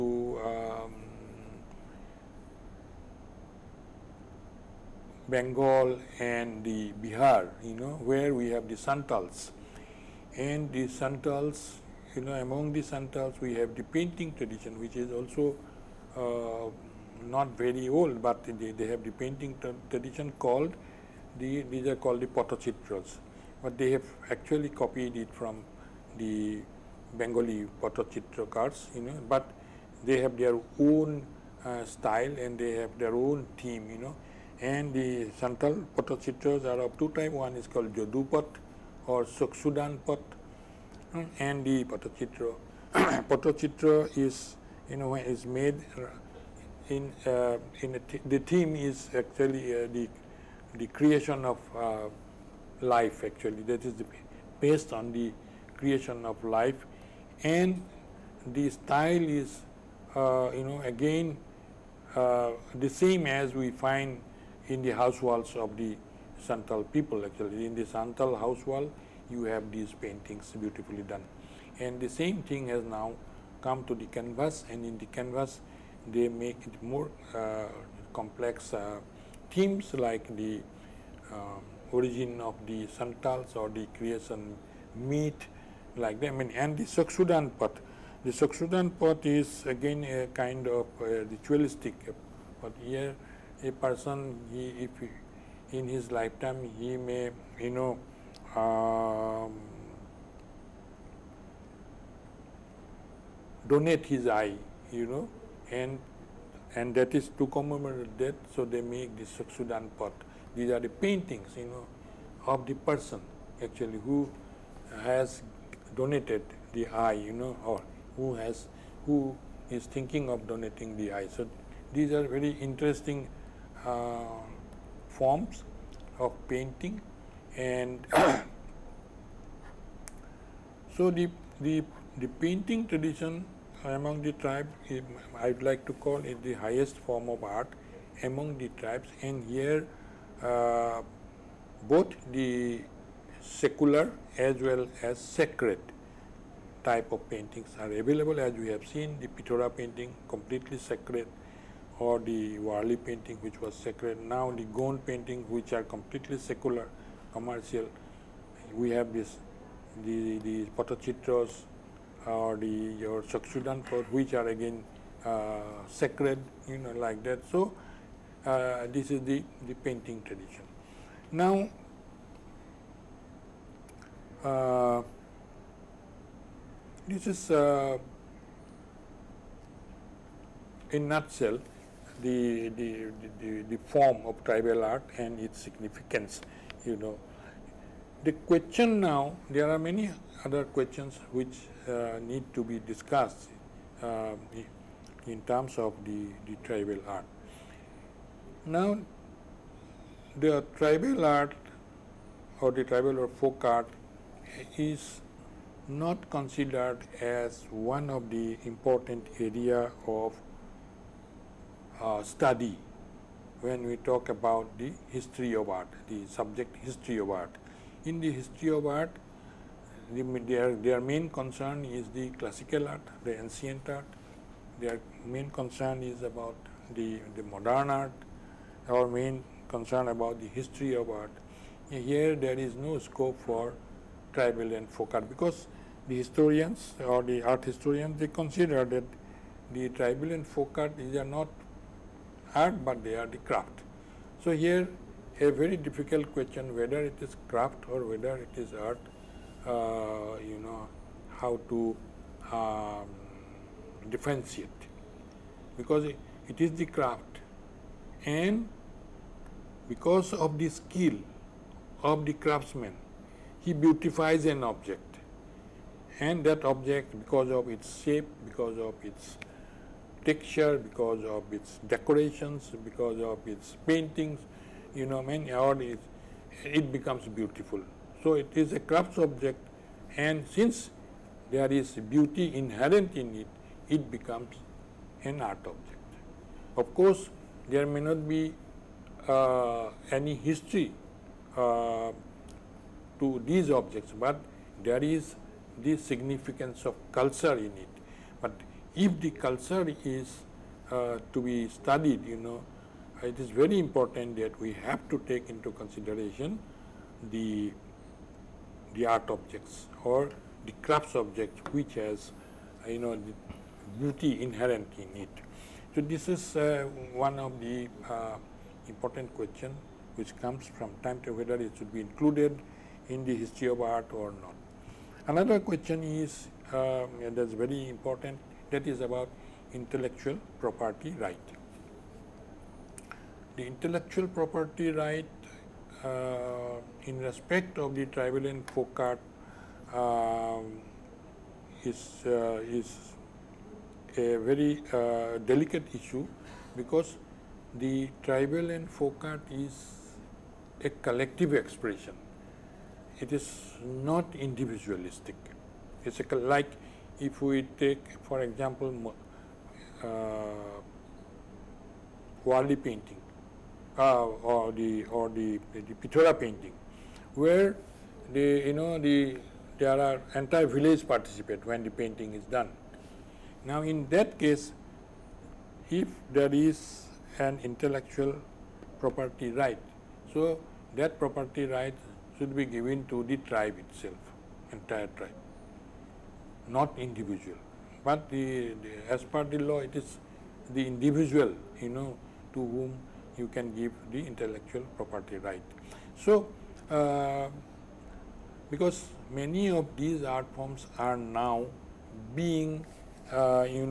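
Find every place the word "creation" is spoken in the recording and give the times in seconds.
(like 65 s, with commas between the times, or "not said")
50 s, 55 s, 83 s.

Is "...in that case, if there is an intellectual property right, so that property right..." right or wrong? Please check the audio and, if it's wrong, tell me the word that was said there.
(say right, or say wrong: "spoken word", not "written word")
right.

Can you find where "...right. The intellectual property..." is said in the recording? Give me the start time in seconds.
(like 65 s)
331 s.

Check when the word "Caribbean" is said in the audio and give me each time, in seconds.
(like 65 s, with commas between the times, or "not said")
not said.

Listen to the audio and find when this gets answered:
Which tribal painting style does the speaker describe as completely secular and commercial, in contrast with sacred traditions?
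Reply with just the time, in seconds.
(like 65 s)
154 s.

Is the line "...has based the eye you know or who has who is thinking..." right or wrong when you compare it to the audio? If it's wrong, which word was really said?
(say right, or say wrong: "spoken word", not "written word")
wrong: "donated", not "based".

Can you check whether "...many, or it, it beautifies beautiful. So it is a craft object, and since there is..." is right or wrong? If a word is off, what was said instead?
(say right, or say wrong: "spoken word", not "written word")
wrong: "becomes", not "beautifies".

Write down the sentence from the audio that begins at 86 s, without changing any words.
I mean, and the Chakshudan pot.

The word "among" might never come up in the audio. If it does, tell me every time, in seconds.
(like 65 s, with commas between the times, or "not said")
12 s, 133 s, 138 s.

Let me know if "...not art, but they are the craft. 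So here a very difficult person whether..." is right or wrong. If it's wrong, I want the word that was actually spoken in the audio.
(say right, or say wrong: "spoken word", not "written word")
wrong: "question", not "person".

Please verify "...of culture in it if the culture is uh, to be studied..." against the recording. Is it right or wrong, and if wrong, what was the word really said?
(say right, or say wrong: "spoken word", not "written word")
right.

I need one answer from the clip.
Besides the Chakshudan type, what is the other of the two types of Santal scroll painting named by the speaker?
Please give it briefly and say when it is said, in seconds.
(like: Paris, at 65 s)
Jodupat, at 37 s.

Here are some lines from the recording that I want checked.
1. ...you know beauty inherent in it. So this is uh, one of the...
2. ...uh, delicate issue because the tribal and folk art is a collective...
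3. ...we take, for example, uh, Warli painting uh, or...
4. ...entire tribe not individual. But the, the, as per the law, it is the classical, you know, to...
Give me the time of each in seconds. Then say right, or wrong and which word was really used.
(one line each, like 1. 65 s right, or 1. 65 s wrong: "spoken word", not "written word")
1. 312 s right
2. 344 s right
3. 357 s right
4. 384 s wrong: "individual", not "classical".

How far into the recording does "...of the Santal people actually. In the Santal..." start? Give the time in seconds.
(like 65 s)
65 s.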